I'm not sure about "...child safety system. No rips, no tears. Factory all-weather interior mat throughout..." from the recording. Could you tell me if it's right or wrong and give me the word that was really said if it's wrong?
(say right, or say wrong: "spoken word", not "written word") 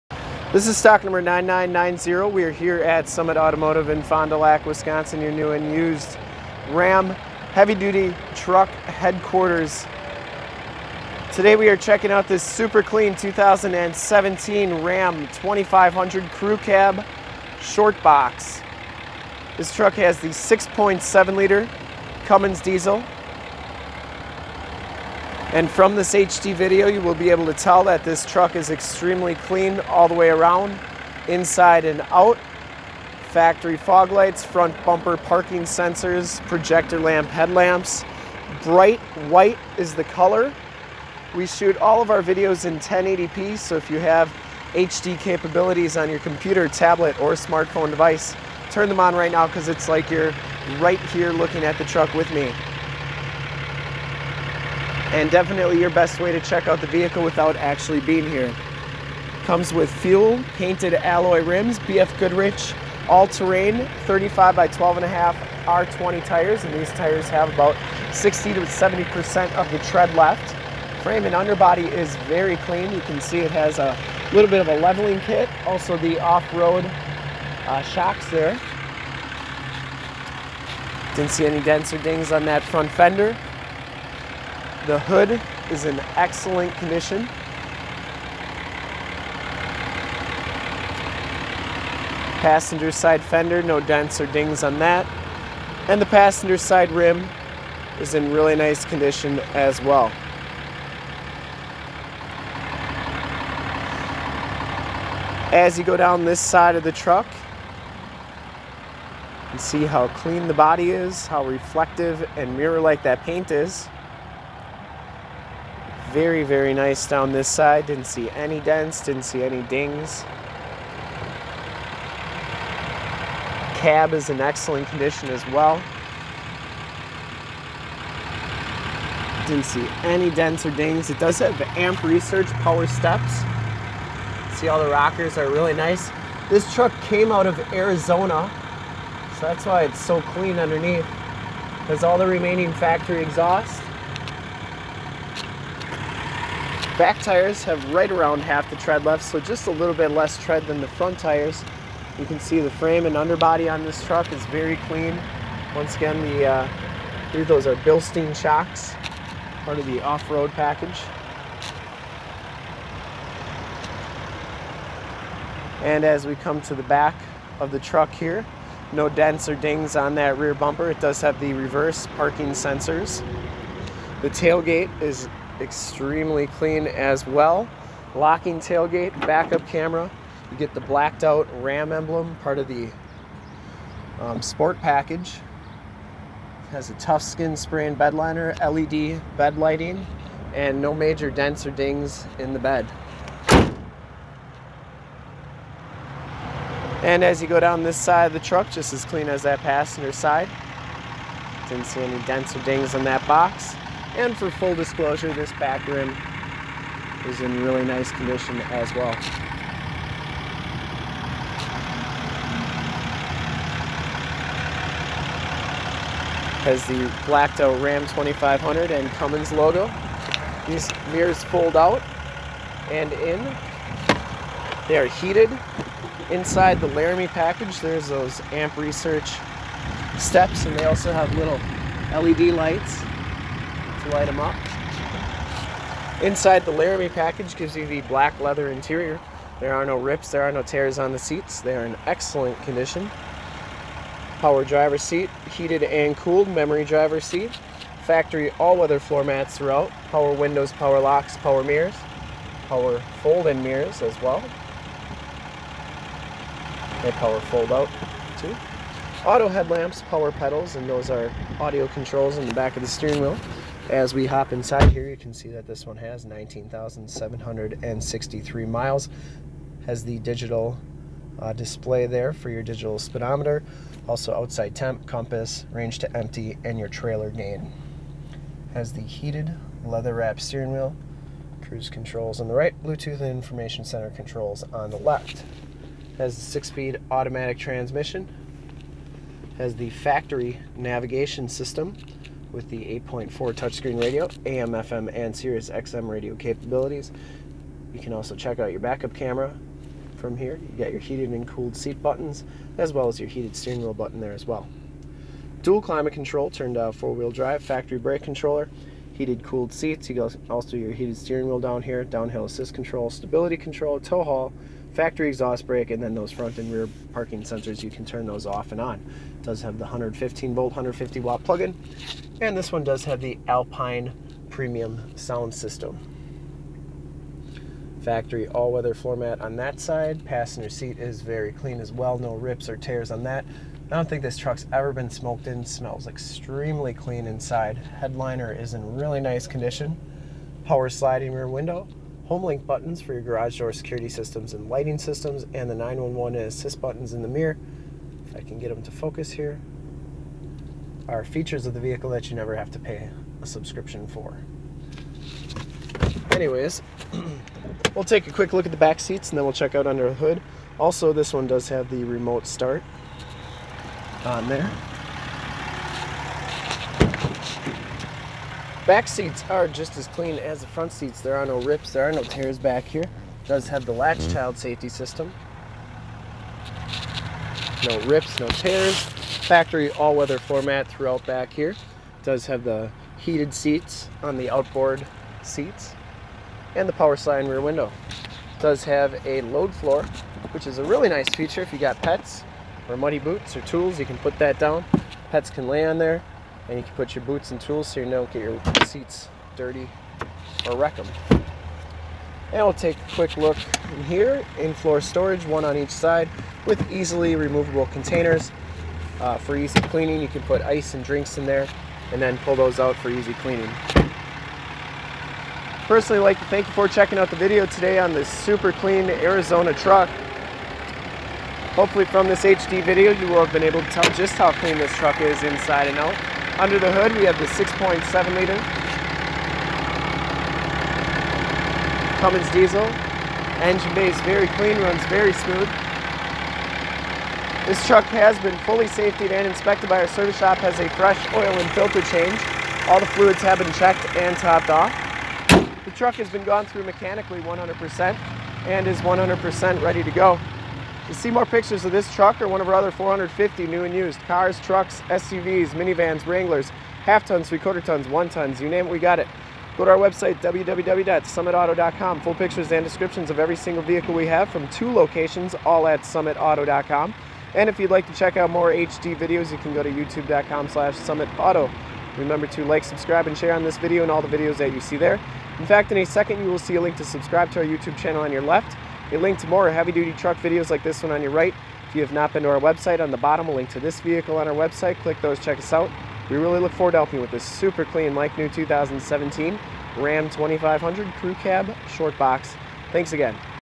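wrong: "floor", not "interior".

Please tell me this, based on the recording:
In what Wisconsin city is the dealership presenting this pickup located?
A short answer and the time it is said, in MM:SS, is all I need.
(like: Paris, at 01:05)
Fond du Lac, at 00:04.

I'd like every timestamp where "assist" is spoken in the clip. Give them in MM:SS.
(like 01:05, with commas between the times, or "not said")
05:12, 05:46.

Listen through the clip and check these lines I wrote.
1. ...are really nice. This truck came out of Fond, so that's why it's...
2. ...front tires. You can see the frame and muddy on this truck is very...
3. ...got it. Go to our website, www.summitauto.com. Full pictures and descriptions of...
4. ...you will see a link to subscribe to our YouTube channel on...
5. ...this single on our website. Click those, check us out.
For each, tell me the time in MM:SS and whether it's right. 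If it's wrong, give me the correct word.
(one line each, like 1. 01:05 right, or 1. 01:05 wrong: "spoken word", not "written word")
1. 02:15 wrong: "Arizona", not "Fond"
2. 02:30 wrong: "underbody", not "muddy"
3. 07:38 right
4. 07:56 right
5. 08:03 wrong: "vehicle", not "single".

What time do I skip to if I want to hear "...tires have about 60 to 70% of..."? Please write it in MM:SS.
01:06.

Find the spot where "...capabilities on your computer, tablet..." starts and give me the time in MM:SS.
00:45.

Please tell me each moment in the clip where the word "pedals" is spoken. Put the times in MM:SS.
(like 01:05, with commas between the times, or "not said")
04:20.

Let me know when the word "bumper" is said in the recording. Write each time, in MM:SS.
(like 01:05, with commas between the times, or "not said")
00:34, 02:50.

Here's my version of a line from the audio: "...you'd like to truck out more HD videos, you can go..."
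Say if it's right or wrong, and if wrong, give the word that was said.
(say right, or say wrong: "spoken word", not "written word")
wrong: "check", not "truck".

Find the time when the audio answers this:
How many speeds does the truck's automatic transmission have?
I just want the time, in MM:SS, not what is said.
04:46.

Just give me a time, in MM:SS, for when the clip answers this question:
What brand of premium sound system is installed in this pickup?
05:23.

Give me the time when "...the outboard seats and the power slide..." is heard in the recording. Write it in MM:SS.
06:24.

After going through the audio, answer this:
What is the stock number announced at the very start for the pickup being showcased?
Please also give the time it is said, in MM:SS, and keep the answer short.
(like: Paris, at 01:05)
9990, at 00:01.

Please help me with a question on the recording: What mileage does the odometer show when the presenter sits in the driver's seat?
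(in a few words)
19,763.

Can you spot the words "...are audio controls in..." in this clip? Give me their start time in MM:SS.
04:21.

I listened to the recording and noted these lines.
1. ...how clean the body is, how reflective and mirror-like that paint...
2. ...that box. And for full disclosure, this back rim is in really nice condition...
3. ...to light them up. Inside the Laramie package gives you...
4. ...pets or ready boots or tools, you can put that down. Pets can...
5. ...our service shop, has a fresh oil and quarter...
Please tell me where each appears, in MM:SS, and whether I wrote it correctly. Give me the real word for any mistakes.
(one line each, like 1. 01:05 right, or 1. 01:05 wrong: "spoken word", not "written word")
1. 01:49 right
2. 03:23 right
3. 03:54 right
4. 06:32 wrong: "muddy", not "ready"
5. 07:20 wrong: "filter", not "quarter".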